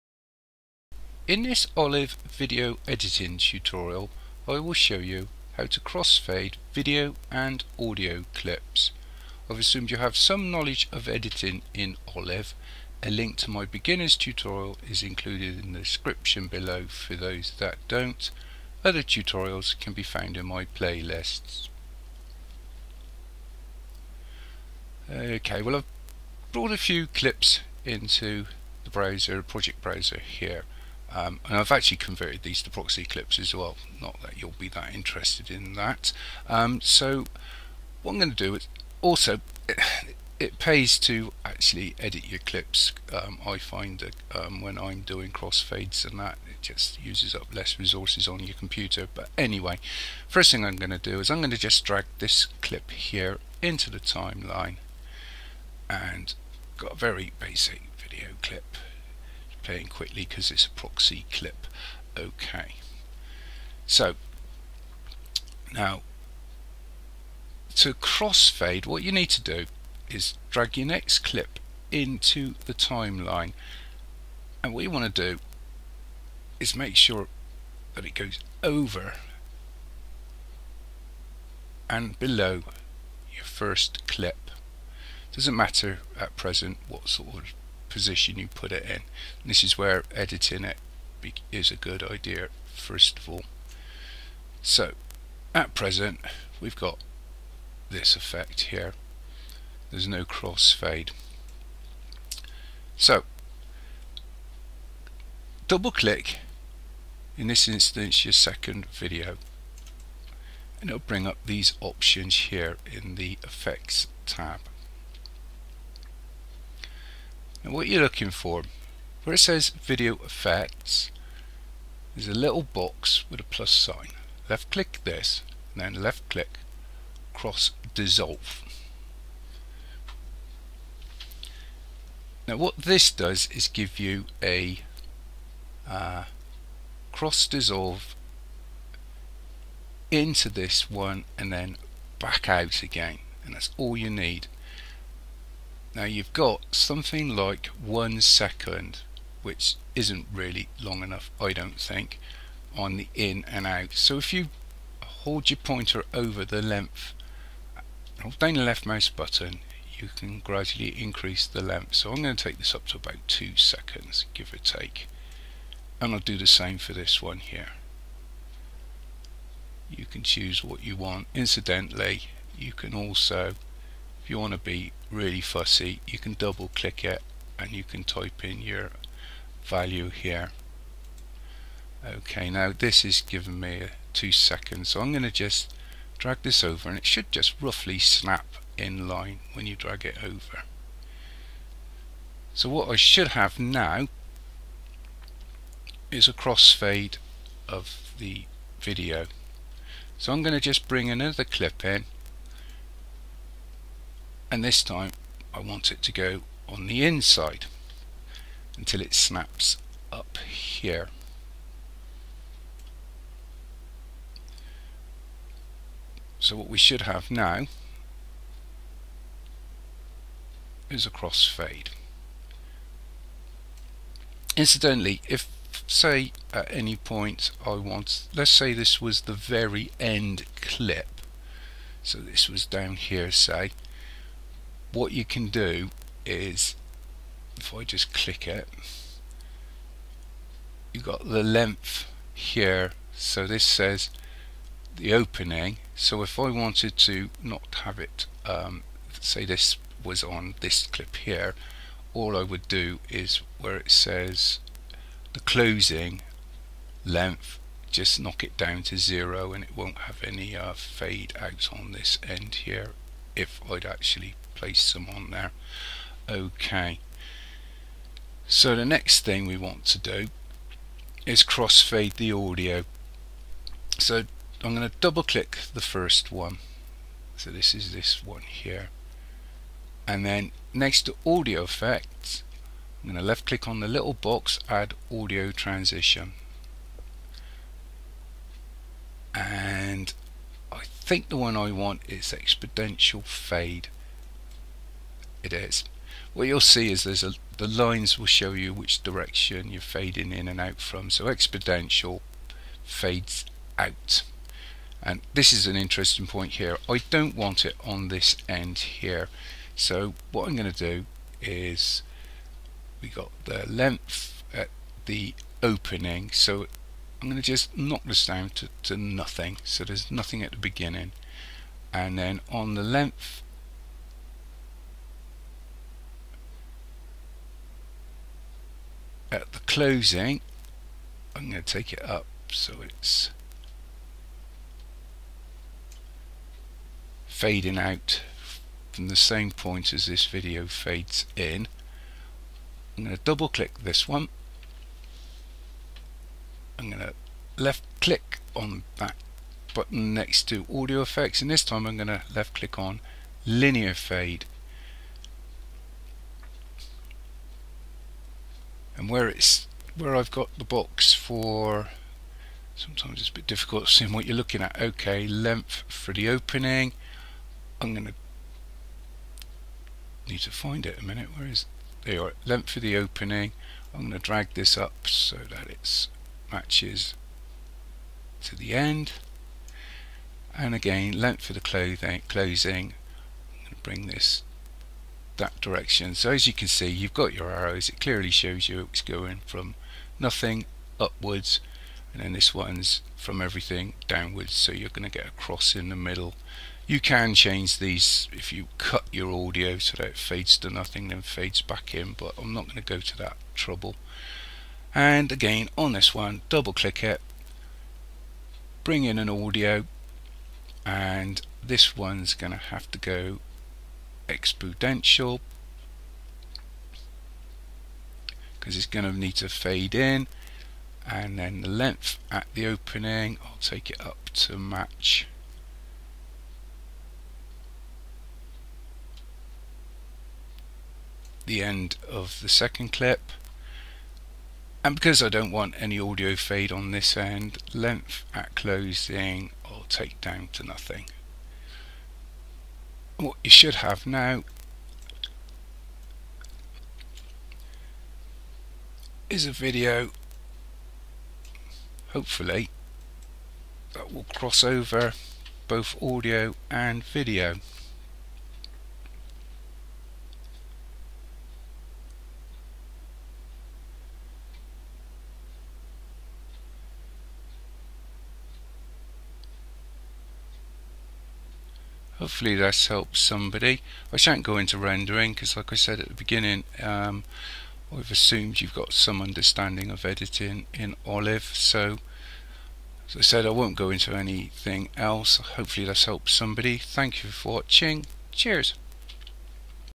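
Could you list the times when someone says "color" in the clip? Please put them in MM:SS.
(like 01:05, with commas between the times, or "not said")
not said.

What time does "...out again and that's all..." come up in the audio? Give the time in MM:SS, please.
02:22.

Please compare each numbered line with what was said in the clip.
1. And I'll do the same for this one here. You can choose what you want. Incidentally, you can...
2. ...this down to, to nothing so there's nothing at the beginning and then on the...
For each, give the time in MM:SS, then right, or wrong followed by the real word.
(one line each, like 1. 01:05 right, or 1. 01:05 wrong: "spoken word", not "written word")
1. 02:45 right
2. 05:18 right.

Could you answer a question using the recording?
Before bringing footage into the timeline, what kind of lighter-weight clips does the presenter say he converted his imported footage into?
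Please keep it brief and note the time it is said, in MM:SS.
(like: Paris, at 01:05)
proxy clips, at 00:32.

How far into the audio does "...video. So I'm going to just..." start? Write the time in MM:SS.
03:18.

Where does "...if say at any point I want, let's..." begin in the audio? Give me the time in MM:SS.
03:45.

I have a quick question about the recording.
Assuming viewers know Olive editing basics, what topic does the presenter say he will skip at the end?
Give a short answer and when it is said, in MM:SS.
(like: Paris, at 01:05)
rendering, at 07:54.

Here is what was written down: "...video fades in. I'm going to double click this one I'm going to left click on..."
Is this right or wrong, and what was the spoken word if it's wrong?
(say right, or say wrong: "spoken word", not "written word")
right.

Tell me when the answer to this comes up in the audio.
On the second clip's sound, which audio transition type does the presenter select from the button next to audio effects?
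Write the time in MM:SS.
05:53.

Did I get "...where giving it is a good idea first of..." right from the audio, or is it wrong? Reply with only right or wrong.
wrong.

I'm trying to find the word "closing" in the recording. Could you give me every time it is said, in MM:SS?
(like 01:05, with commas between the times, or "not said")
04:15, 05:29, 06:22, 07:18.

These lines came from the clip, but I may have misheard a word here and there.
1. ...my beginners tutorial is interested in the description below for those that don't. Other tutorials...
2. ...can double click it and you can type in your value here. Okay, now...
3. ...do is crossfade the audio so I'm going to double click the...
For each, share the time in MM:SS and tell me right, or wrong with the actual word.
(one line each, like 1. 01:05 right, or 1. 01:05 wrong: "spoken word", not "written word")
1. 00:13 wrong: "included", not "interested"
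2. 02:56 right
3. 04:29 right.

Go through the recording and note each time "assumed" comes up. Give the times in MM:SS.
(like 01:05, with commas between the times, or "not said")
00:09, 07:58.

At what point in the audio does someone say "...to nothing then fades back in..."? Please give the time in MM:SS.
06:40.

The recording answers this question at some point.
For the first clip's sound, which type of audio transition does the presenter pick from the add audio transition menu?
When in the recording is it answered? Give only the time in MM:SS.
04:52.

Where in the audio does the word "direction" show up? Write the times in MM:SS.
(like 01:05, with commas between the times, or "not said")
04:59, 06:25.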